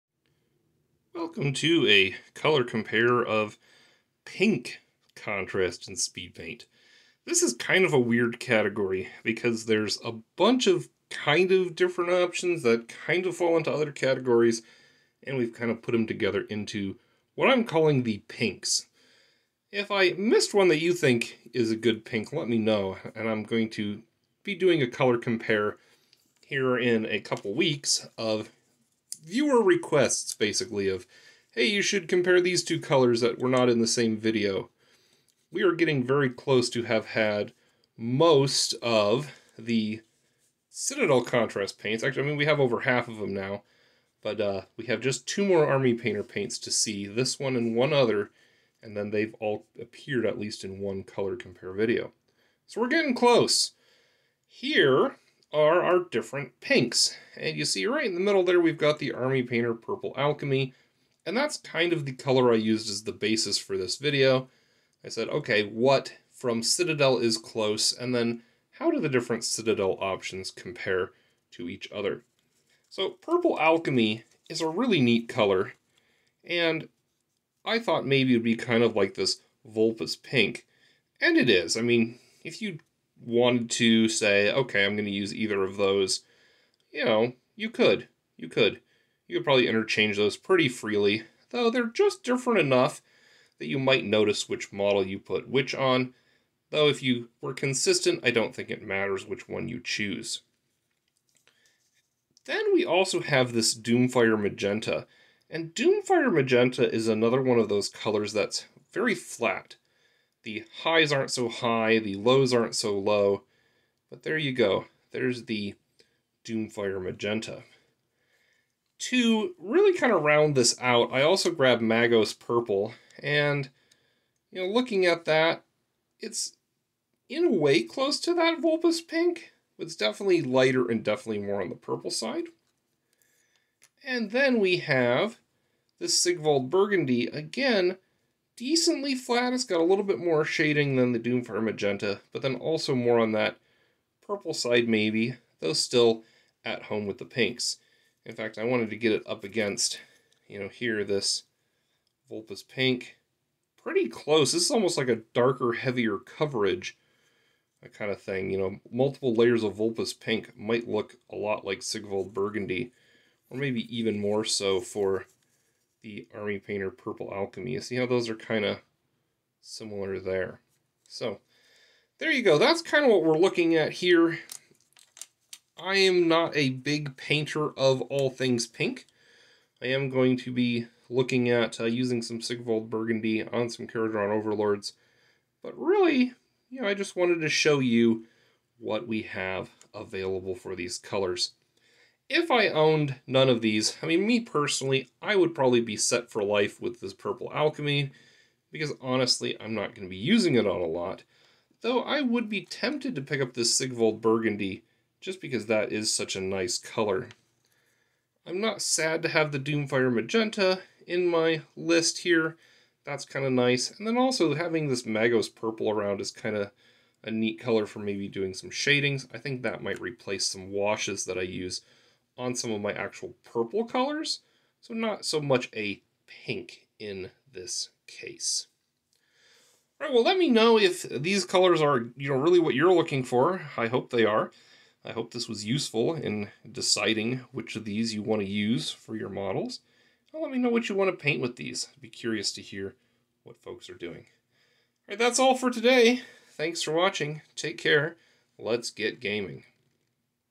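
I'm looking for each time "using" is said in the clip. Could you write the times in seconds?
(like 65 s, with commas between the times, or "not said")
181 s, 200 s.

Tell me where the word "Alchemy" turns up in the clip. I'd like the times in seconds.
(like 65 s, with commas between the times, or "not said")
60 s, 73 s, 167 s, 197 s.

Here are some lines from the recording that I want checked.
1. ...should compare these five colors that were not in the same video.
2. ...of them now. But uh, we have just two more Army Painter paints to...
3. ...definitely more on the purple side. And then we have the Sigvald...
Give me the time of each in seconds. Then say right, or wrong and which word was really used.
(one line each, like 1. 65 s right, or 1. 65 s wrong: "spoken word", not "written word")
1. 31 s wrong: "two", not "five"
2. 43 s right
3. 131 s right.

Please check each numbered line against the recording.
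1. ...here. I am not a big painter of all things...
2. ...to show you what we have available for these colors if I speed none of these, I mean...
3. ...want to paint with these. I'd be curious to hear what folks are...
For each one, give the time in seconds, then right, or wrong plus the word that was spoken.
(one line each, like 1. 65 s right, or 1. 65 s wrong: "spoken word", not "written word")
1. 173 s right
2. 187 s wrong: "owned", not "speed"
3. 240 s right.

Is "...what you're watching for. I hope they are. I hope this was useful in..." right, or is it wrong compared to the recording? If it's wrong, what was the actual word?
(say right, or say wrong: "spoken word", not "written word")
wrong: "looking", not "watching".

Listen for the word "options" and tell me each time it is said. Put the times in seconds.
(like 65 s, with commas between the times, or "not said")
12 s, 69 s.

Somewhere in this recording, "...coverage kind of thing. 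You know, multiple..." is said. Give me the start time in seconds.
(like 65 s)
156 s.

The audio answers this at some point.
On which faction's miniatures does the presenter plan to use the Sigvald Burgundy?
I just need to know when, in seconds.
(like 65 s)
183 s.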